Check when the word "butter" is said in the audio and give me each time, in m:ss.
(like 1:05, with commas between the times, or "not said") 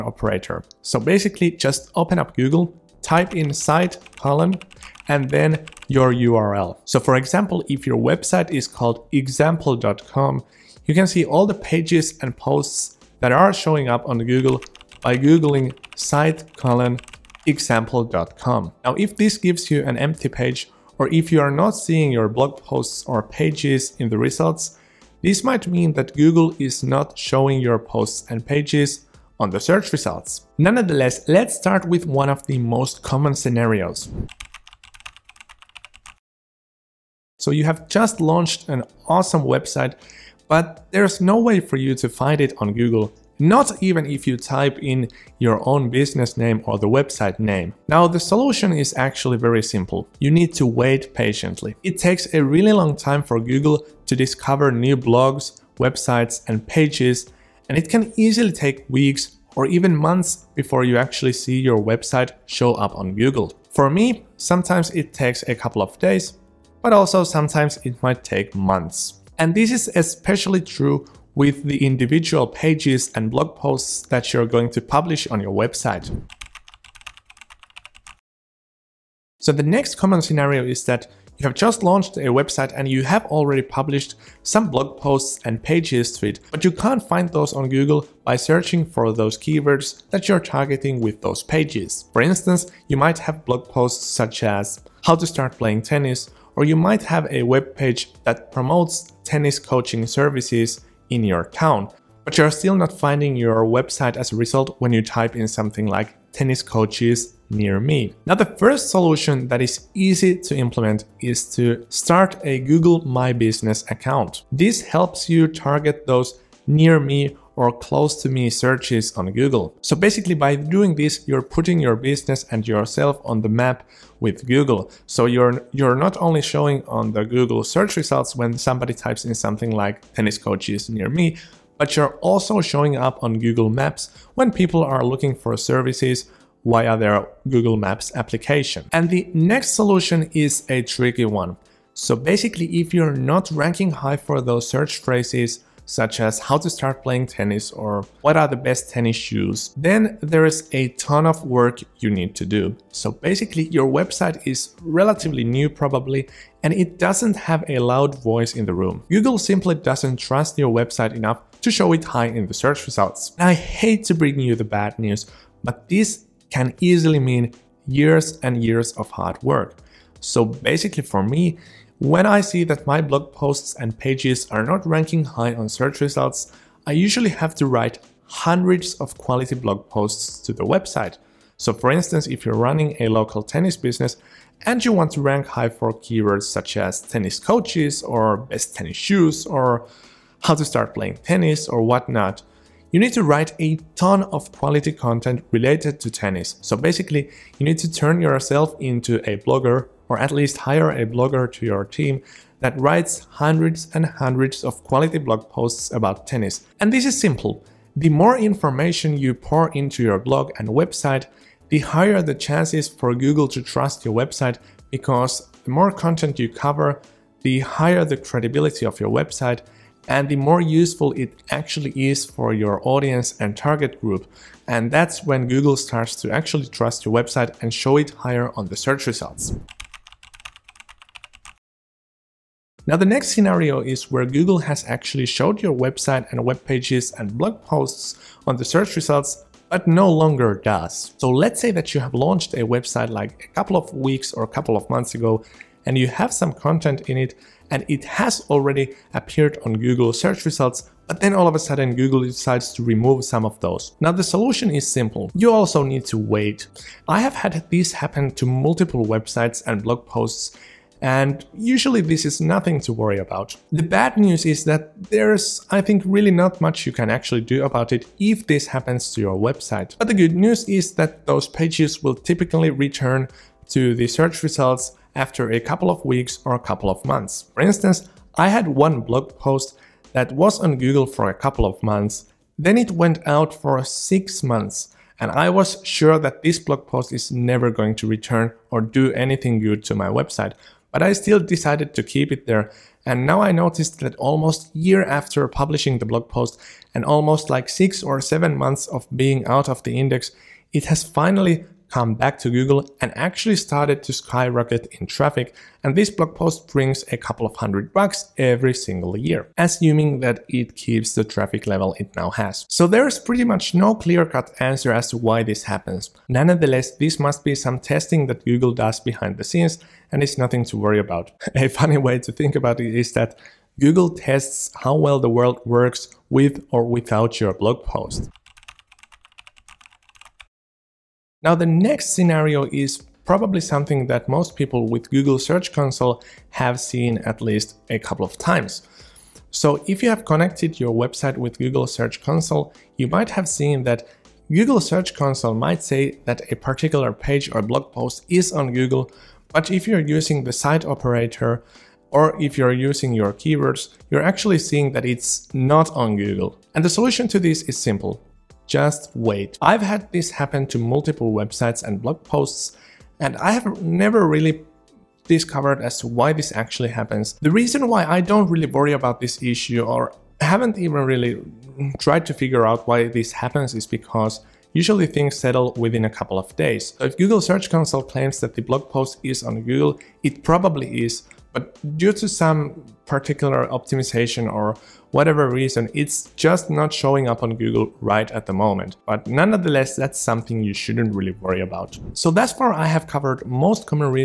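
not said.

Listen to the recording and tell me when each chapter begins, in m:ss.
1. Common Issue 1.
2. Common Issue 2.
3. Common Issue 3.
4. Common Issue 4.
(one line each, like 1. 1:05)
1. 0:33
2. 1:14
3. 3:48
4. 5:27.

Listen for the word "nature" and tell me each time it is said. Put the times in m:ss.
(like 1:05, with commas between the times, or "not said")
not said.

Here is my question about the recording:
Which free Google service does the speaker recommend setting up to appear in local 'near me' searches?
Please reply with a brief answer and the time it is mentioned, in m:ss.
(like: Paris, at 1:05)
Google My Business, at 1:52.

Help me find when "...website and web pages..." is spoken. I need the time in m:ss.
3:55.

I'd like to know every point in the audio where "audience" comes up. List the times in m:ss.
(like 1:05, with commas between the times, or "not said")
3:42.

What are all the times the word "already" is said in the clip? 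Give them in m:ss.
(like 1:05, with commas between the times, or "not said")
1:23, 4:08.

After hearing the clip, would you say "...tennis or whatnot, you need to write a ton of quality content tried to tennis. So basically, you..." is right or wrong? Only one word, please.
wrong.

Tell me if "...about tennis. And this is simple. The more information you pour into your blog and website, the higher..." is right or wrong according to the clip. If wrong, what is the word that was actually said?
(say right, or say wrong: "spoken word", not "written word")
right.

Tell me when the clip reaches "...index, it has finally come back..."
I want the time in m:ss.
4:59.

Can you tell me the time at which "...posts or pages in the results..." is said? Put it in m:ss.
0:22.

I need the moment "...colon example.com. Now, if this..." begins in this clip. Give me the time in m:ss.
0:16.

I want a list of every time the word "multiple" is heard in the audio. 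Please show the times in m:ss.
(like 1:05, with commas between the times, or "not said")
4:18, 6:00.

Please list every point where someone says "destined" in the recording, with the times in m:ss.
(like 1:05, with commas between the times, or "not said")
not said.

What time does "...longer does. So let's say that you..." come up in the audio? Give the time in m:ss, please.
4:00.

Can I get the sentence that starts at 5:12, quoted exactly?
So there's pretty much no clear-cut answer as to why this happens.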